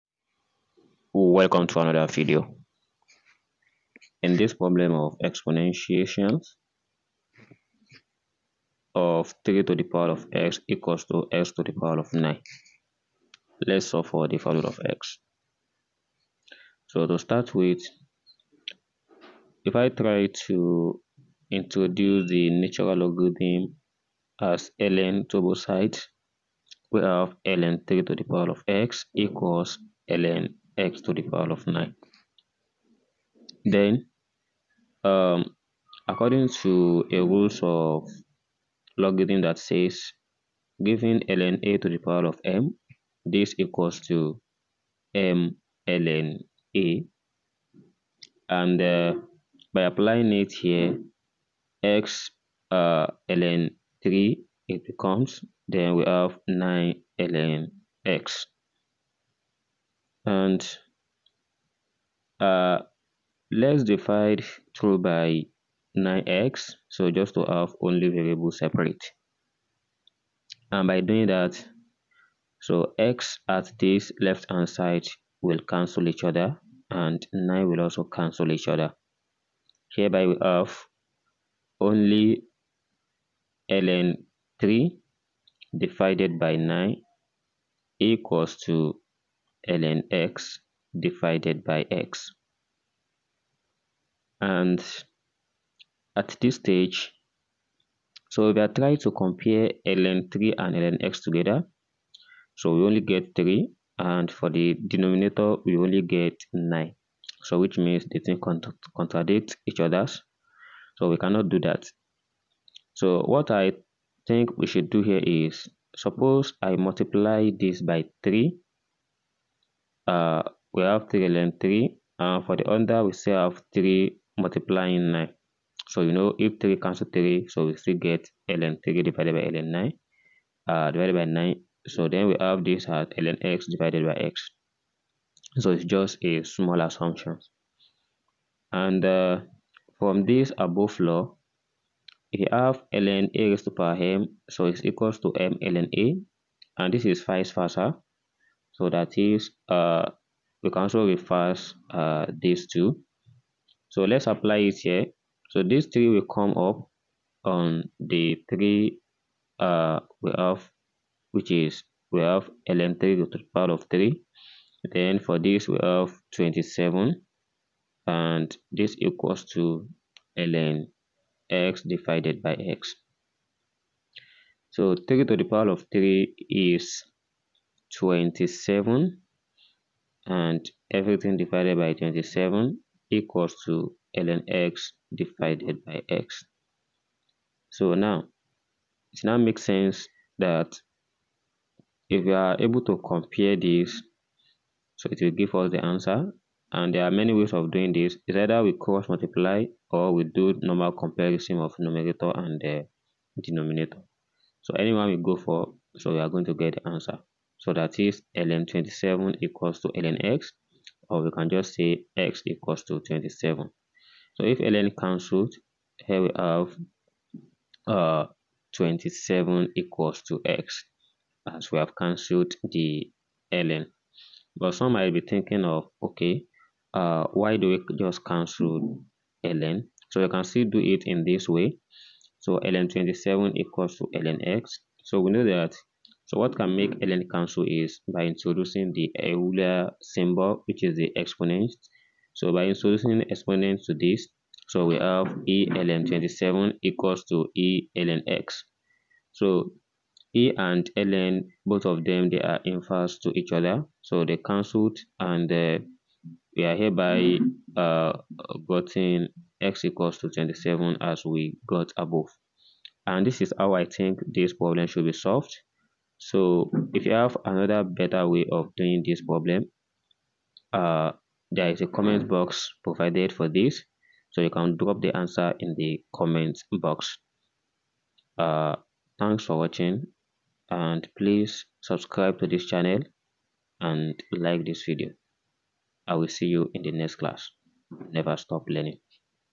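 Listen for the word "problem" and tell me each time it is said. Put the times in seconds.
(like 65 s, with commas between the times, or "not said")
4 s, 264 s, 269 s.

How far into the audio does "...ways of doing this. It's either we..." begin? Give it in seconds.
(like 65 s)
197 s.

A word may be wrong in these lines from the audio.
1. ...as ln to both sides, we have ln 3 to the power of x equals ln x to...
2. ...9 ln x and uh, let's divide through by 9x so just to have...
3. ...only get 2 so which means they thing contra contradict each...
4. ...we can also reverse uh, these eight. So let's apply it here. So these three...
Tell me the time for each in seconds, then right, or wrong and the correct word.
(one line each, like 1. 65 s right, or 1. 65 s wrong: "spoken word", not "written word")
1. 24 s right
2. 56 s right
3. 105 s wrong: "9", not "2"
4. 150 s wrong: "two", not "eight".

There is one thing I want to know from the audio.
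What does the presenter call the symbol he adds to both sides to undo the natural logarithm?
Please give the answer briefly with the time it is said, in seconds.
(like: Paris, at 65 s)
Euler symbol, at 239 s.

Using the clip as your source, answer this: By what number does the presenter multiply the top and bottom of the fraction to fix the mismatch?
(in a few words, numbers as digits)
3.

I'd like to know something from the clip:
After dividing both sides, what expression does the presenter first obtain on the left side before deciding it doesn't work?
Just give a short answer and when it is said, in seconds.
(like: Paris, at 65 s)
ln 3 divided by 9, at 83 s.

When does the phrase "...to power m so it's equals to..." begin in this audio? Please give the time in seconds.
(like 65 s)
143 s.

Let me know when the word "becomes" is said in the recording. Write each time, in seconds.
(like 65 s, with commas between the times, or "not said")
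54 s.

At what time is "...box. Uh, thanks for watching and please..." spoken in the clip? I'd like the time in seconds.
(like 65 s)
276 s.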